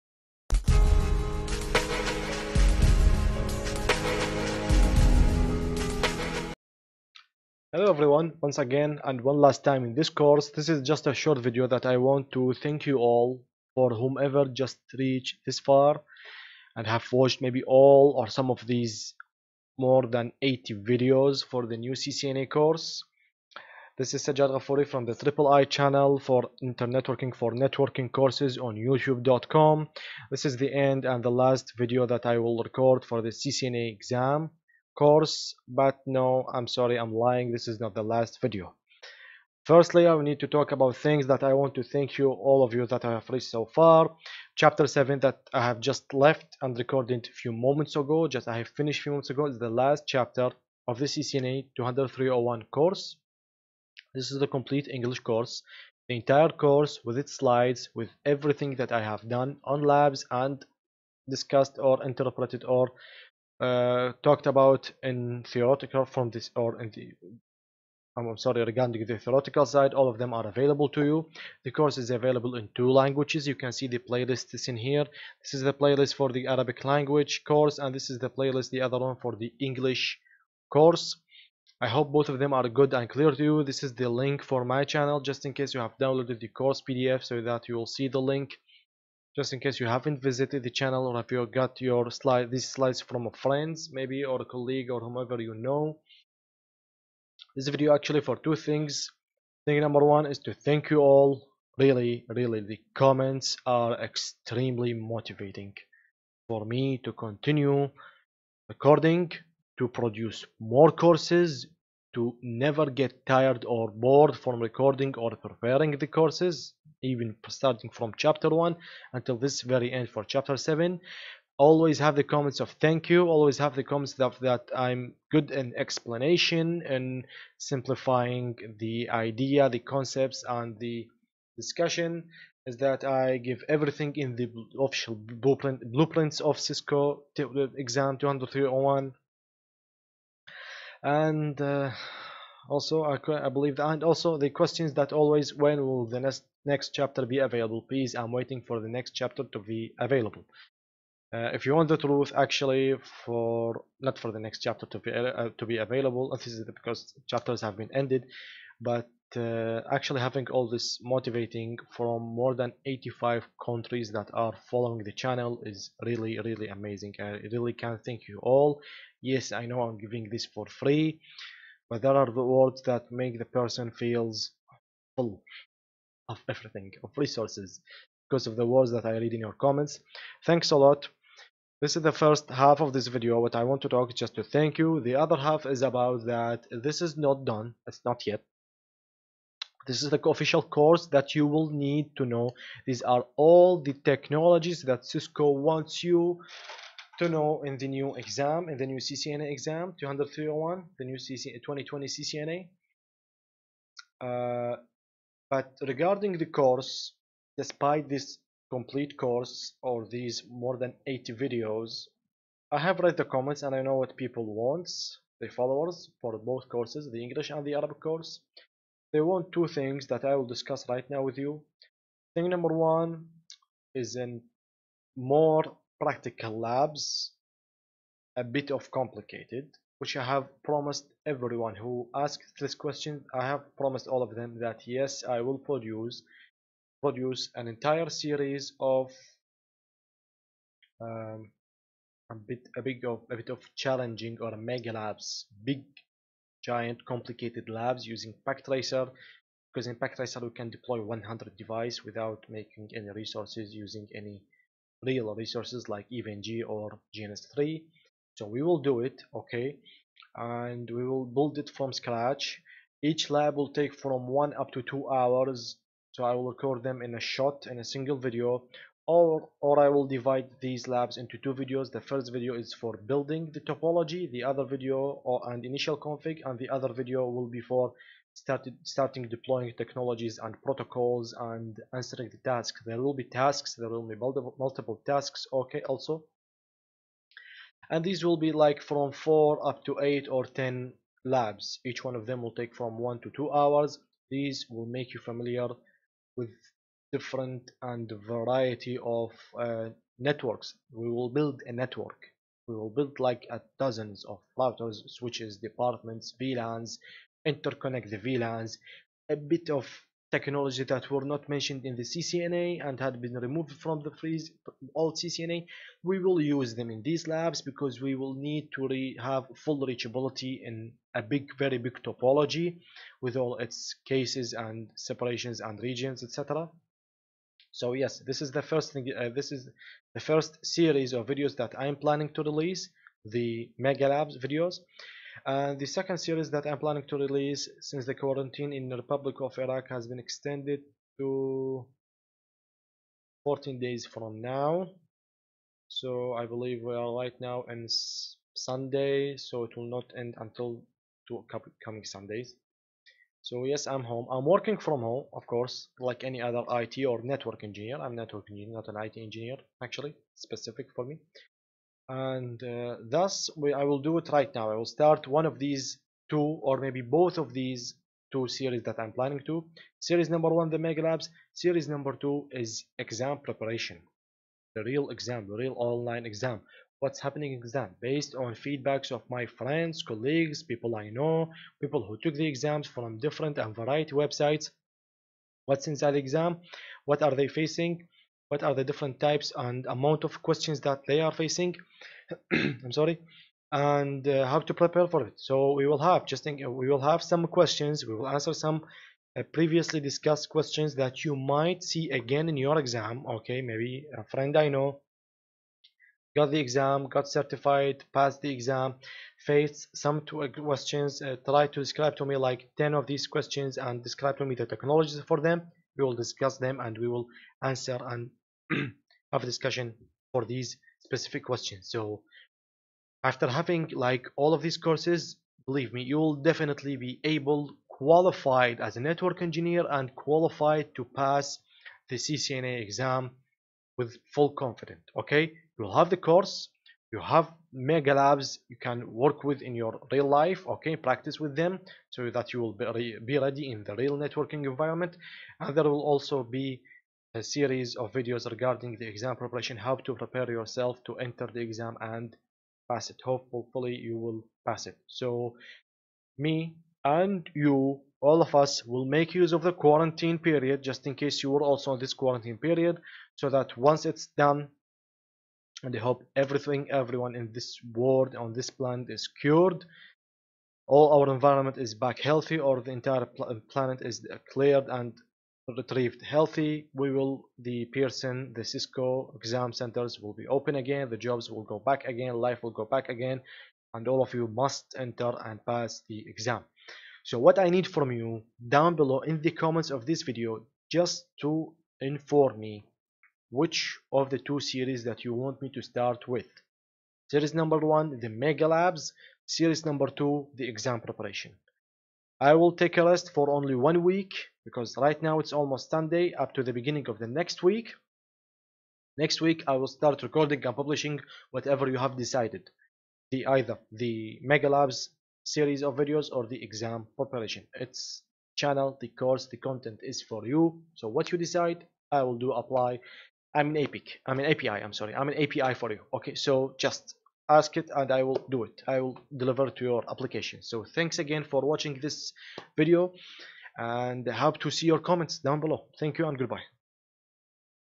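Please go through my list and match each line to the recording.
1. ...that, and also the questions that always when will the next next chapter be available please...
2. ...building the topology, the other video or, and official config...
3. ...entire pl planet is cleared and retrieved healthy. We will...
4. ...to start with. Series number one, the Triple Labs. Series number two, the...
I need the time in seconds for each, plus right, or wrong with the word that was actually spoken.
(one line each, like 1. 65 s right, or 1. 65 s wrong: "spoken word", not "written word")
1. 143 s right
2. 273 s wrong: "initial", not "official"
3. 472 s right
4. 495 s wrong: "Mega", not "Triple".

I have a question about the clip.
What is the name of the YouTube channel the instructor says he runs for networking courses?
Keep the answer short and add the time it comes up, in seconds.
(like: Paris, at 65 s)
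Triple I, at 25 s.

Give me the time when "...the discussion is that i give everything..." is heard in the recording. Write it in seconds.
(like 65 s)
130 s.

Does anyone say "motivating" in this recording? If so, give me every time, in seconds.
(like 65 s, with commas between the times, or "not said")
104 s, 161 s.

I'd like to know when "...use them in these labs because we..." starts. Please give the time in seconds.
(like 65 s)
316 s.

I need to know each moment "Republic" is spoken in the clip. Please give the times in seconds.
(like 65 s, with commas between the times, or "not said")
338 s.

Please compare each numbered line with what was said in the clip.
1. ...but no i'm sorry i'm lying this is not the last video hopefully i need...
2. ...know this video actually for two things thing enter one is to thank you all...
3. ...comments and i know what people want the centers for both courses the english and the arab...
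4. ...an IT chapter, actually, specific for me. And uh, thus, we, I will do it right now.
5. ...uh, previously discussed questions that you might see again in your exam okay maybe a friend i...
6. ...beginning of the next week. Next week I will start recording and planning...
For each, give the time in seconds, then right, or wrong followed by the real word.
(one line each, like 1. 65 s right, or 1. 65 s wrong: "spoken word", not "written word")
1. 35 s wrong: "firstly", not "hopefully"
2. 95 s wrong: "number", not "enter"
3. 213 s wrong: "followers", not "centers"
4. 358 s wrong: "engineer", not "chapter"
5. 399 s right
6. 506 s wrong: "publishing", not "planning".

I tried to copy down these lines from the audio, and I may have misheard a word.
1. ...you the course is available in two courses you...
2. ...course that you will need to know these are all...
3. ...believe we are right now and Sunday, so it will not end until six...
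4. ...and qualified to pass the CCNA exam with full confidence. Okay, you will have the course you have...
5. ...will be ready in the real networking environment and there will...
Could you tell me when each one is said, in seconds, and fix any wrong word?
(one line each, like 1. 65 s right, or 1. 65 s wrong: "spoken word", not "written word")
1. 71 s wrong: "languages", not "courses"
2. 190 s right
3. 346 s wrong: "two", not "six"
4. 429 s right
5. 442 s right.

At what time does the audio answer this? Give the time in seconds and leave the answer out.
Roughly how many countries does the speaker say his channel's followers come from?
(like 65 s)
162 s.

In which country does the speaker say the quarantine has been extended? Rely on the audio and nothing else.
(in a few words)
Iraq.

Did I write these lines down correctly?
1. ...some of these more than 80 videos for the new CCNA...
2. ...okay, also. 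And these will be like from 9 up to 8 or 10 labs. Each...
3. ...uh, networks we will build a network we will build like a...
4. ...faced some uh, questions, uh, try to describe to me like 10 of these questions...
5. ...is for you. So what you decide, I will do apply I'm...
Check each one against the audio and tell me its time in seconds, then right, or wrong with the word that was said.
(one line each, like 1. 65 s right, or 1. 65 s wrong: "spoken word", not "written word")
1. 18 s right
2. 285 s wrong: "4", not "9"
3. 299 s right
4. 409 s right
5. 520 s right.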